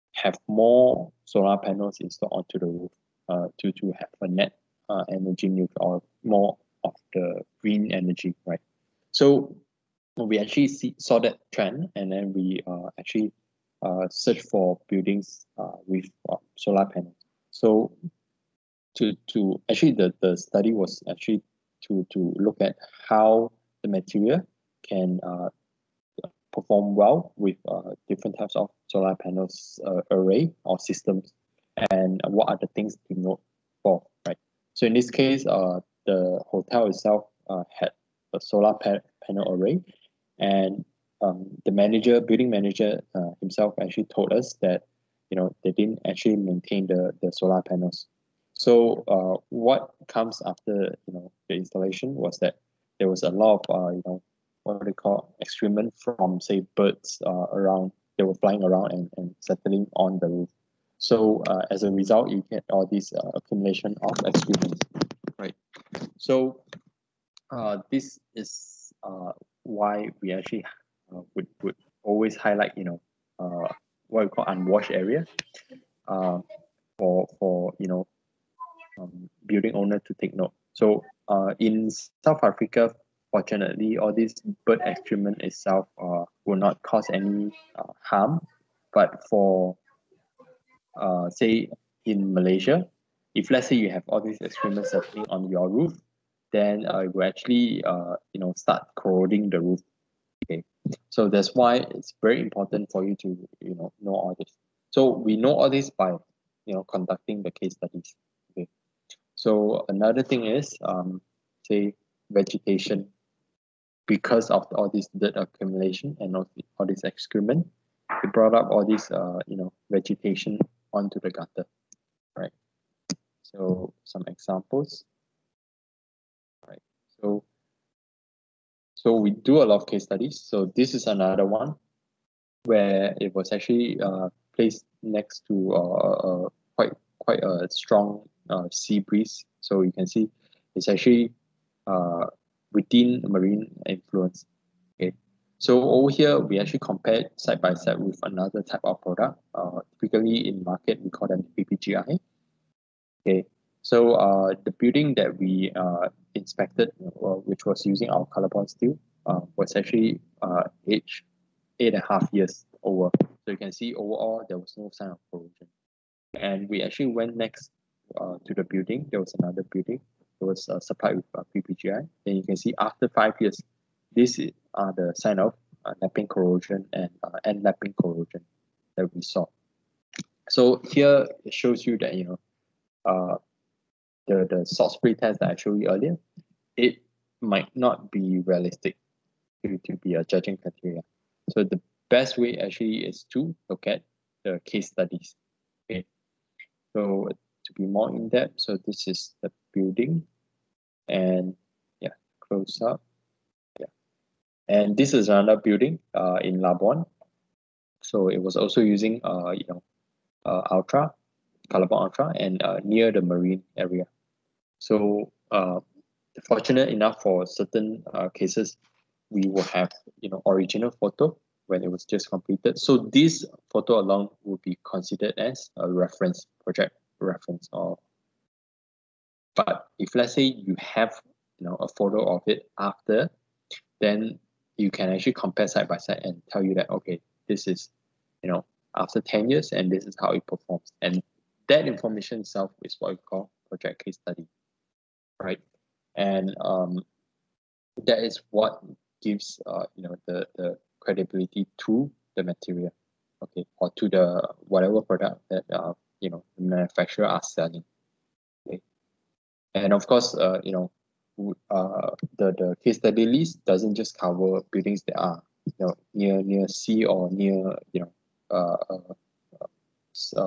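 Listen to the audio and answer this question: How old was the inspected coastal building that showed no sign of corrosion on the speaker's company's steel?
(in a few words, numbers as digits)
8 and a half years.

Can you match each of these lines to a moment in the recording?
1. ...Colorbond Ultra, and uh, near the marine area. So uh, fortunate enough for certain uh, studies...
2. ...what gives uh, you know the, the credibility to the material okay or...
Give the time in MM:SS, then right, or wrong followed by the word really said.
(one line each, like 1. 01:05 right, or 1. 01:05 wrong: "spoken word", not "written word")
1. 03:31 wrong: "cases", not "studies"
2. 04:08 right.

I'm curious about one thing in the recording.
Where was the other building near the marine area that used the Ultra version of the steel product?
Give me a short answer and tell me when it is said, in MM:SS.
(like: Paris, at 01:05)
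Labuan, at 03:26.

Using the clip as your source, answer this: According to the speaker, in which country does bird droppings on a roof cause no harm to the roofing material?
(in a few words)
South Africa.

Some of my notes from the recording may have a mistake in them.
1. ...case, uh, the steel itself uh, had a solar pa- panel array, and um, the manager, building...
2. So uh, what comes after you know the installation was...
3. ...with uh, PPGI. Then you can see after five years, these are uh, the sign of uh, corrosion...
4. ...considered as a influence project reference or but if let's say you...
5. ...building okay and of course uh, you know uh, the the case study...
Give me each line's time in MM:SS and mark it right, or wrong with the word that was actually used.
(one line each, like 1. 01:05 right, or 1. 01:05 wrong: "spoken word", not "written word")
1. 00:35 wrong: "hotel", not "steel"
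2. 00:48 right
3. 02:51 right
4. 03:44 wrong: "reference", not "influence"
5. 04:17 wrong: "selling", not "building".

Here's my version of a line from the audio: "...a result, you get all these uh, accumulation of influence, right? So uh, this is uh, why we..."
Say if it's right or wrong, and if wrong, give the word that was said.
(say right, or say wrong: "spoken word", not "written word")
wrong: "experience", not "influence".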